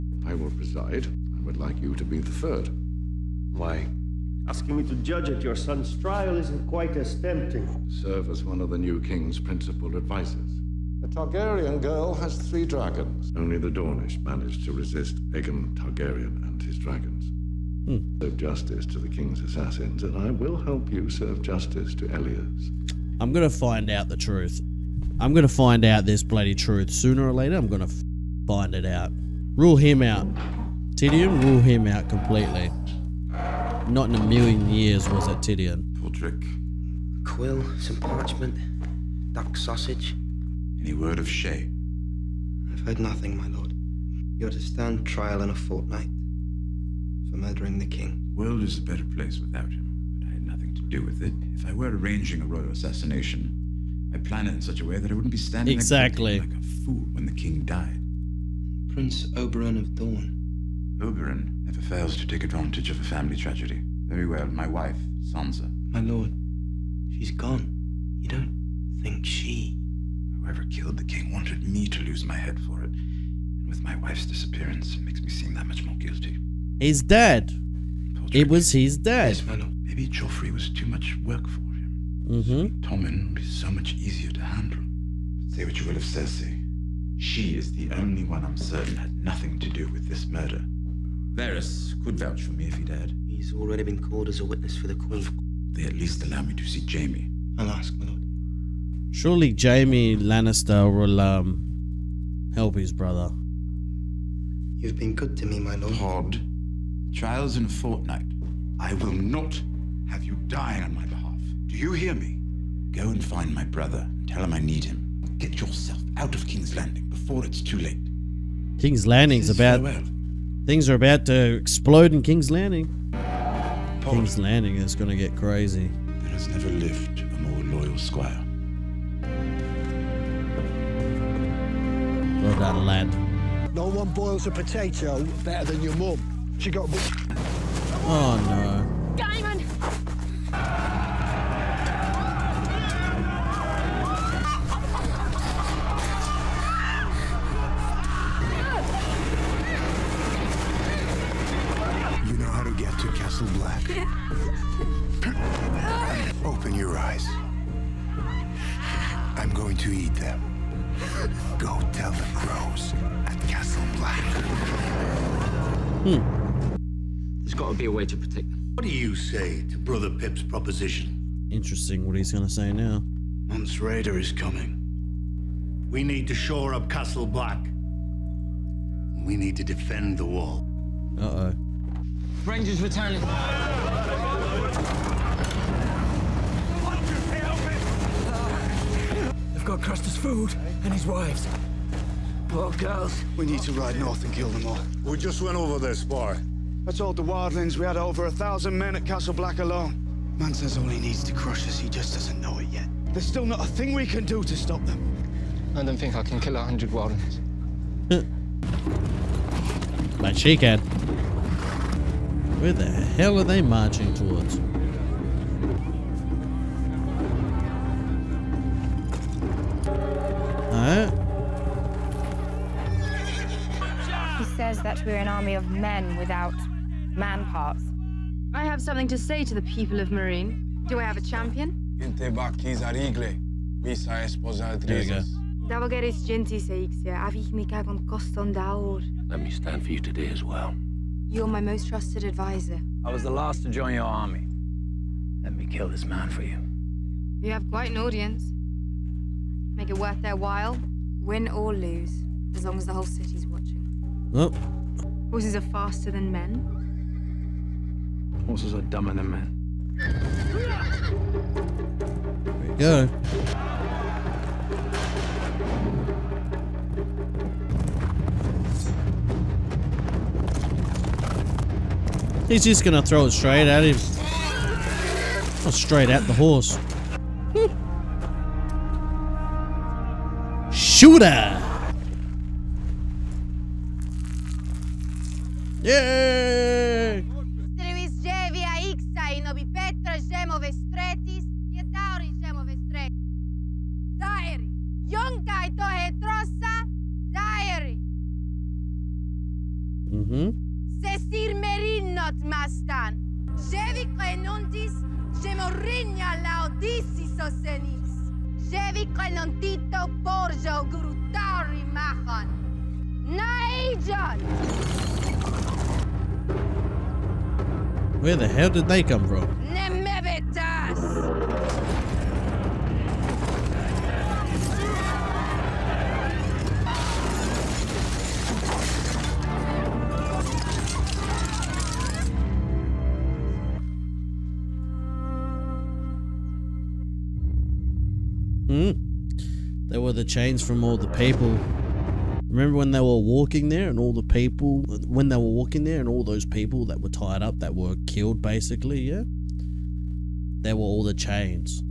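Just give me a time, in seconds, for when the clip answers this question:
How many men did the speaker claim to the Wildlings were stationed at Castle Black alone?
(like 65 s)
197 s.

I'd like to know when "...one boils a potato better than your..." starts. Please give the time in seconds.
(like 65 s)
133 s.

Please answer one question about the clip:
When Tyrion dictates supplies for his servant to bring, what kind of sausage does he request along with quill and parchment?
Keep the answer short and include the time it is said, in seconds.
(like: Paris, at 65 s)
duck sausage, at 39 s.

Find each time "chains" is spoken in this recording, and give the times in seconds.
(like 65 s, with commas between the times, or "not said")
340 s, 351 s.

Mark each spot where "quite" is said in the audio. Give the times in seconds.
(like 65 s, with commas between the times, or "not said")
6 s, 247 s.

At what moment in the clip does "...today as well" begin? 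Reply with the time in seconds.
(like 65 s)
239 s.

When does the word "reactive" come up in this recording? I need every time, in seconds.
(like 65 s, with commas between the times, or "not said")
not said.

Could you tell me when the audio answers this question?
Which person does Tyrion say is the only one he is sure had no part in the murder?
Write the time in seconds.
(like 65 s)
86 s.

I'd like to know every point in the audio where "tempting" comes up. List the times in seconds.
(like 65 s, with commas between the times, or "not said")
7 s.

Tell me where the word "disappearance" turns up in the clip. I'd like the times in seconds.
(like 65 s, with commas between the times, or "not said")
74 s.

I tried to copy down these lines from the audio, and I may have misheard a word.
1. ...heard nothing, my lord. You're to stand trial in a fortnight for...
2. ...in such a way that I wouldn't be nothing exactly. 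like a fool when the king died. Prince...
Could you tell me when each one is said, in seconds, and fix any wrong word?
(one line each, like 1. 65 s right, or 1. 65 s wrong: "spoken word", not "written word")
1. 42 s right
2. 54 s wrong: "standing", not "nothing".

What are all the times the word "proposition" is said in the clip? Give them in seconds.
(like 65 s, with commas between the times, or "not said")
170 s.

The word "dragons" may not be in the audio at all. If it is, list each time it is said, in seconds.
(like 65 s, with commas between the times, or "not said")
12 s, 16 s.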